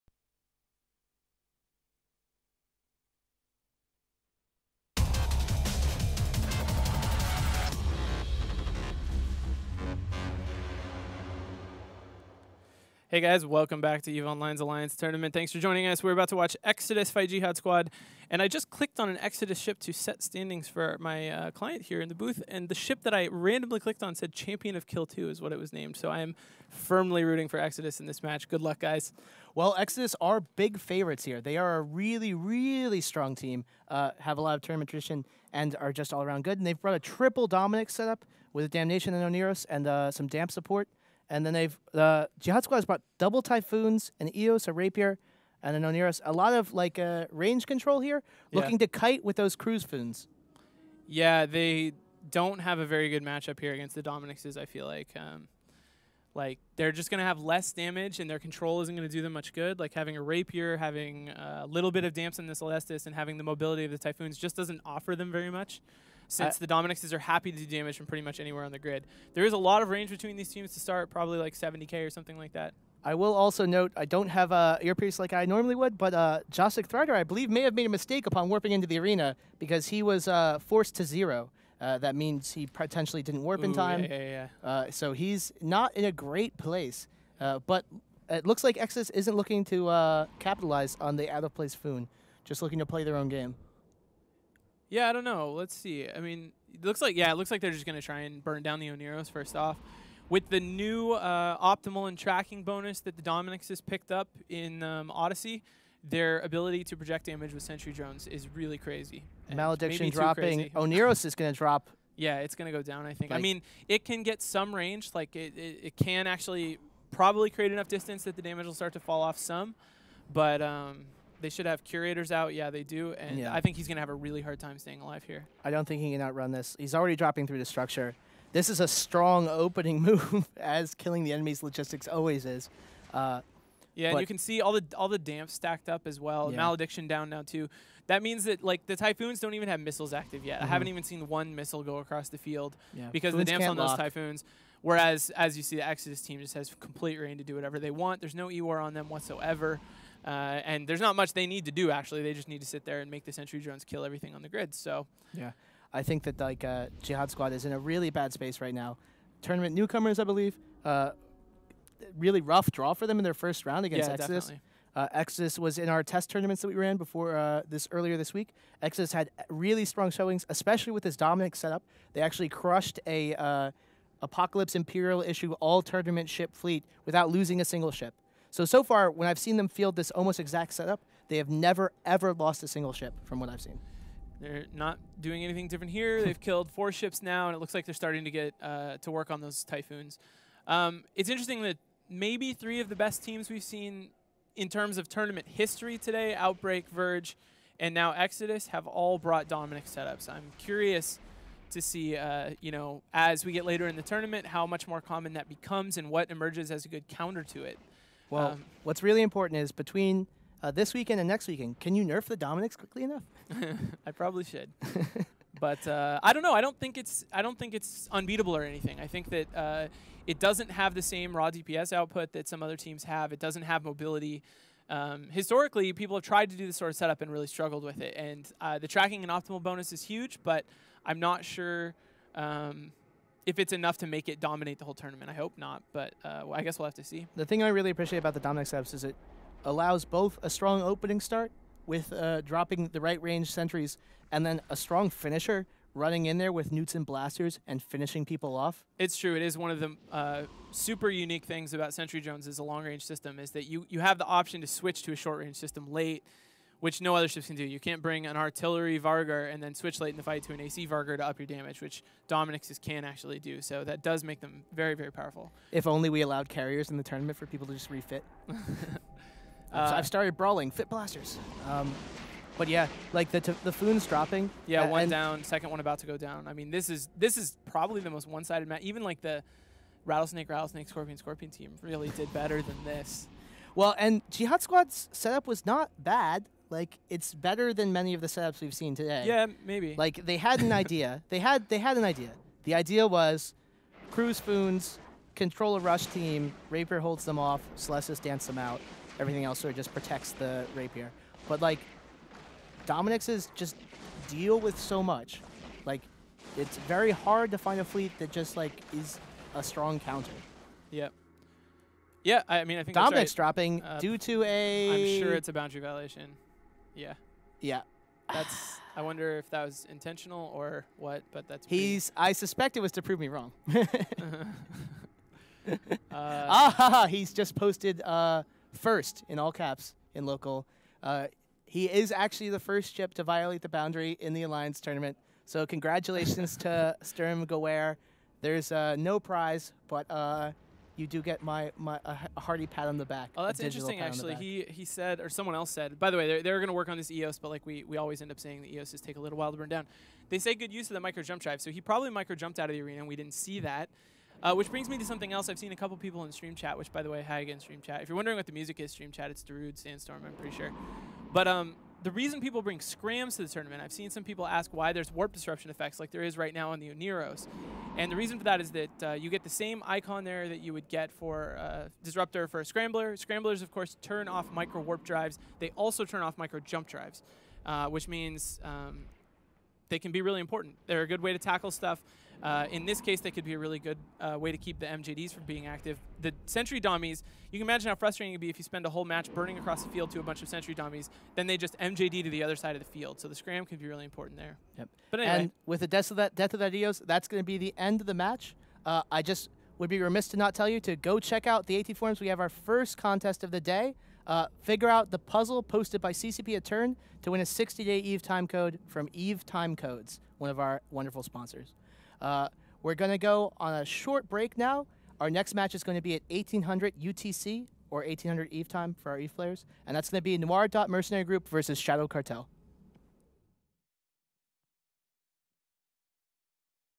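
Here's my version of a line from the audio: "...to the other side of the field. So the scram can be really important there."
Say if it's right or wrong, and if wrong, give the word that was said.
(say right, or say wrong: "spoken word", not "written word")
right.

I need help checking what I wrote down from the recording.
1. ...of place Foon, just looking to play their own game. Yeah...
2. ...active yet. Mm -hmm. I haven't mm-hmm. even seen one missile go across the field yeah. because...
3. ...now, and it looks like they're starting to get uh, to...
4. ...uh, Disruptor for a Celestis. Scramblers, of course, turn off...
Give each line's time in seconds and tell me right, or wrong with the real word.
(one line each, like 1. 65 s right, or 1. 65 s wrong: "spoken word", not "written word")
1. 91 s right
2. 140 s right
3. 187 s right
4. 371 s wrong: "Scrambler", not "Celestis".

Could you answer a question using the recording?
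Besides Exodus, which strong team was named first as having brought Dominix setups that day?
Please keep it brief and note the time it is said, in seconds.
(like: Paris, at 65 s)
Outbreak, at 196 s.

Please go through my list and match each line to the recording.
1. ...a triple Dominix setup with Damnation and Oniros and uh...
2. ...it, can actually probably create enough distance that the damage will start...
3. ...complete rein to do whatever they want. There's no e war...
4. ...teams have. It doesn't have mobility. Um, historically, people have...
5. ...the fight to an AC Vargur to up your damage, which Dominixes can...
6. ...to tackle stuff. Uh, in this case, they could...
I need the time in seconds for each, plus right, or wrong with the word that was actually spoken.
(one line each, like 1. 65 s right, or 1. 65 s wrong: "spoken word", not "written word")
1. 36 s right
2. 115 s right
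3. 146 s right
4. 222 s right
5. 260 s right
6. 381 s right.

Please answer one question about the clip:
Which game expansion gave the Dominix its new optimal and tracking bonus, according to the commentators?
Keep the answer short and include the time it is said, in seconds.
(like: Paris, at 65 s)
Odyssey, at 105 s.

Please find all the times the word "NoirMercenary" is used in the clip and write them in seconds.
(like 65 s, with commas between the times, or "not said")
420 s.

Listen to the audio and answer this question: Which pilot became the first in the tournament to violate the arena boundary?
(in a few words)
Sturm Gewehr.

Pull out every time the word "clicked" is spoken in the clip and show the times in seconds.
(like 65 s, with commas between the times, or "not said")
18 s, 23 s.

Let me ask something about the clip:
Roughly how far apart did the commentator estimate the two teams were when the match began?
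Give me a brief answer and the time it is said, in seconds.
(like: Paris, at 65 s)
70k, at 71 s.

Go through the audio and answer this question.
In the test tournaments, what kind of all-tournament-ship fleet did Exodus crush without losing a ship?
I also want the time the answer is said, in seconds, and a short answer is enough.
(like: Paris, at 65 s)
Apocalypse Imperial issue, at 174 s.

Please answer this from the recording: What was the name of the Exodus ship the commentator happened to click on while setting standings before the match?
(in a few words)
Champion of Kill 2.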